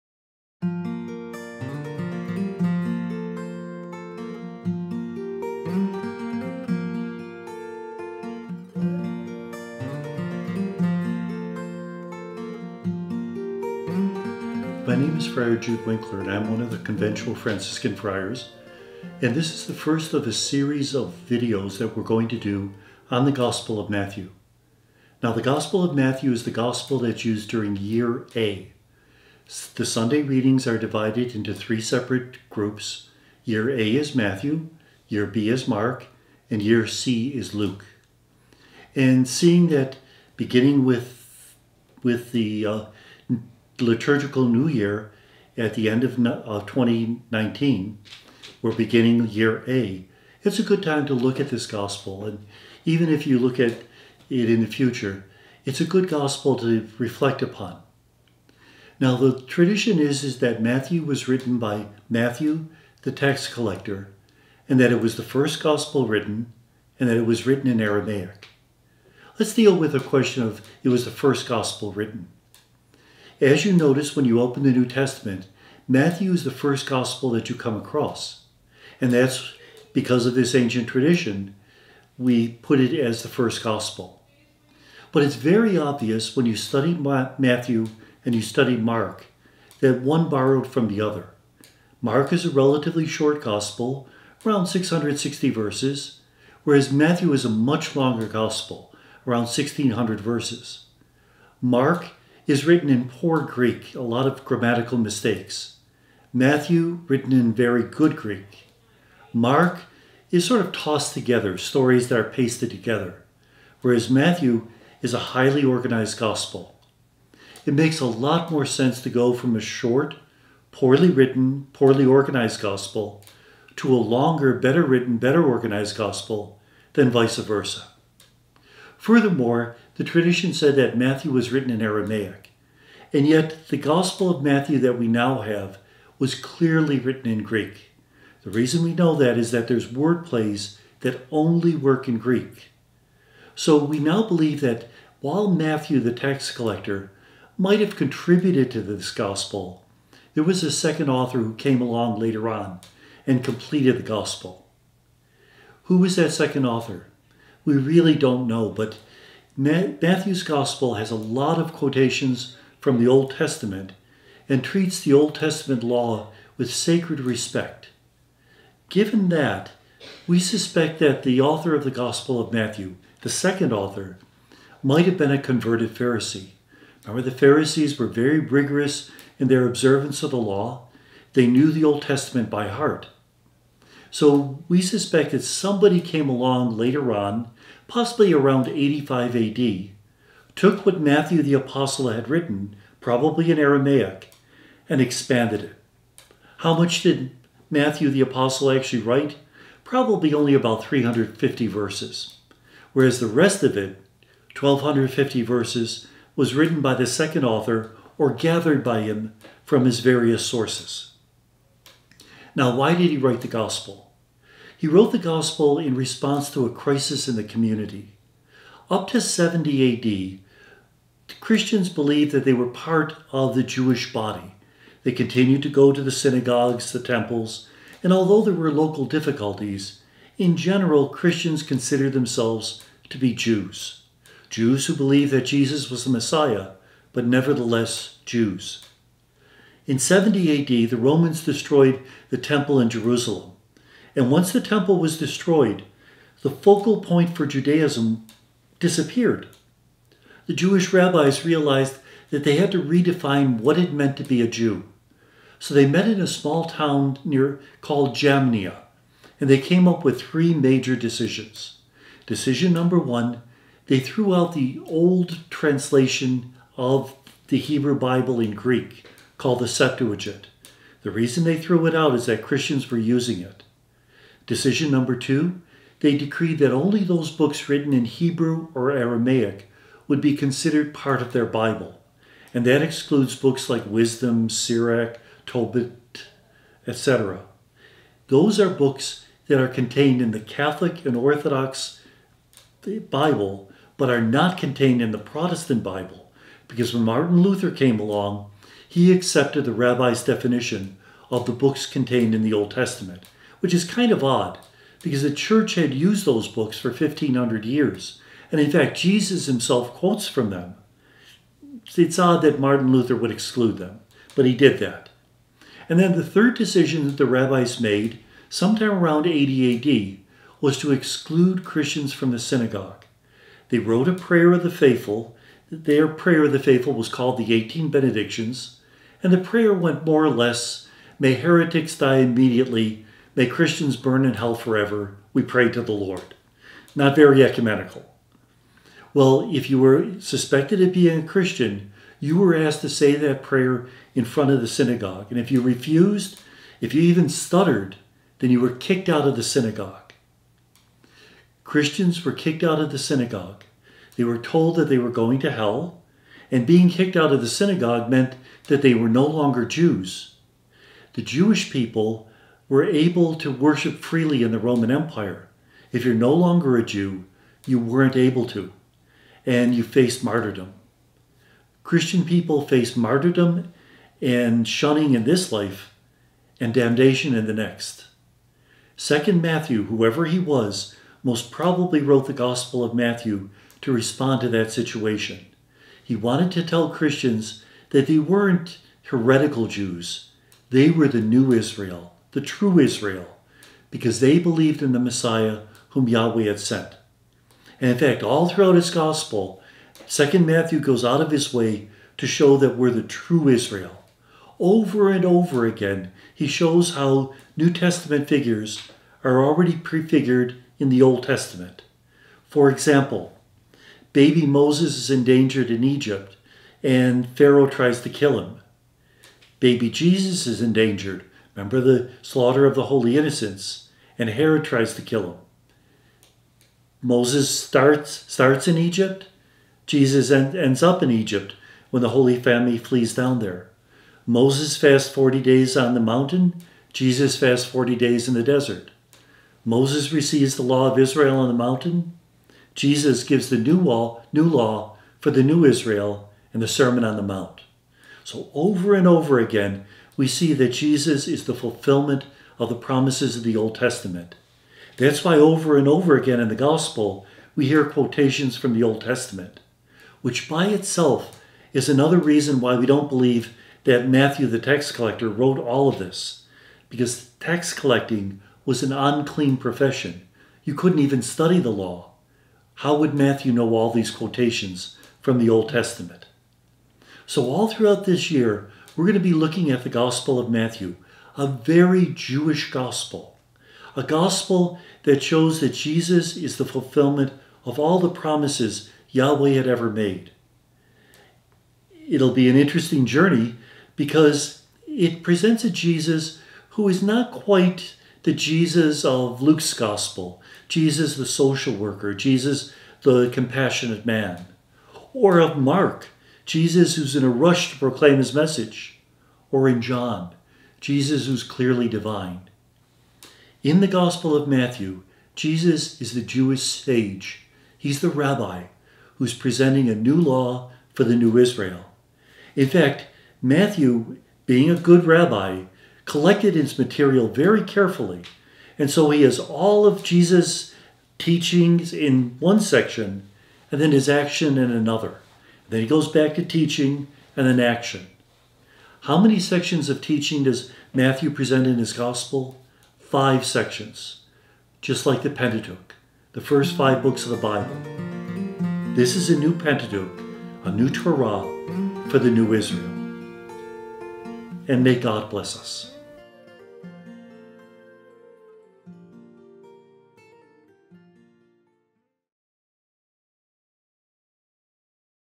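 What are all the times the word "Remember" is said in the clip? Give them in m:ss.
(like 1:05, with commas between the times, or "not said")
2:57, 7:01.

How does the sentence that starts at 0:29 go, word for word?
The Sunday readings are divided into three separate groups.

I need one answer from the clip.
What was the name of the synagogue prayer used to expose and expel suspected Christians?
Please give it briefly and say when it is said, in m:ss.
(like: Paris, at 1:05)
18 Benedictions, at 5:27.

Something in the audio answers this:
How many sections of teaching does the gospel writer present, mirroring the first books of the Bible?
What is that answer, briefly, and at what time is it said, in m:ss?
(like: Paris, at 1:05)
5, at 9:02.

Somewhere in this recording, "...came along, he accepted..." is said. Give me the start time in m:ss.
4:57.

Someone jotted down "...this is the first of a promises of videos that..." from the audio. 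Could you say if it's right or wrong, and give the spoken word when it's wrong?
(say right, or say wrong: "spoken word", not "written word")
wrong: "series", not "promises".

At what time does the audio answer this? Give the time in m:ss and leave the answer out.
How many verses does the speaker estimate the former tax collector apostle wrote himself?
3:20.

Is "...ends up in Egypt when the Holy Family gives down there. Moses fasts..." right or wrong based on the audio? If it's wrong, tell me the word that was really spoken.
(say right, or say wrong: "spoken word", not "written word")
wrong: "flees", not "gives".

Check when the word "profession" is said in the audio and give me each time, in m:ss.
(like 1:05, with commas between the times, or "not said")
7:49.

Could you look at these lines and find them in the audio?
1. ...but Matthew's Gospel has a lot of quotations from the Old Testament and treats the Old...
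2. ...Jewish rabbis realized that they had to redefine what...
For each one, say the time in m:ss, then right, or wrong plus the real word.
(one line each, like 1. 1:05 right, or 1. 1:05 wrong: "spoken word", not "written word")
1. 2:38 right
2. 4:10 right.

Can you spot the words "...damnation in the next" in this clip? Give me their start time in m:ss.
6:16.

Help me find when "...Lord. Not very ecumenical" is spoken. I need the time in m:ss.
5:35.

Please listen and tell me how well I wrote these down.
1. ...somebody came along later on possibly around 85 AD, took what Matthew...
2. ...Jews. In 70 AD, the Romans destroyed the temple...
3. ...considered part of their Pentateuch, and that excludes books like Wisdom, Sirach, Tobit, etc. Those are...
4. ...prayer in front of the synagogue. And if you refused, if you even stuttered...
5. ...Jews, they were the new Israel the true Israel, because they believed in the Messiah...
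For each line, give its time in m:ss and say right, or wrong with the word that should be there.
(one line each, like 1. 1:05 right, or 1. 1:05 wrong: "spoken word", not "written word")
1. 3:05 right
2. 3:58 right
3. 4:40 wrong: "Bible", not "Pentateuch"
4. 5:43 right
5. 6:29 right.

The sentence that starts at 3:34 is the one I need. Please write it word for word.
He wrote the gospel in response to a crisis in the community.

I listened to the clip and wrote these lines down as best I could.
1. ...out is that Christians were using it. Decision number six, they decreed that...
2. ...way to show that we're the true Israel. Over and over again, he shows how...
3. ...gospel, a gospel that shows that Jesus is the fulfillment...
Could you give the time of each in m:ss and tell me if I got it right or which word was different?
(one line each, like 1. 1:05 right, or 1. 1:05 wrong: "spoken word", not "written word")
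1. 4:31 wrong: "two", not "six"
2. 6:41 right
3. 8:02 right.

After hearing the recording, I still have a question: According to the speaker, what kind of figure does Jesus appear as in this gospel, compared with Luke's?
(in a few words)
Jewish sage.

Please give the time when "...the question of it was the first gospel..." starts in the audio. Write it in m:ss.
1:09.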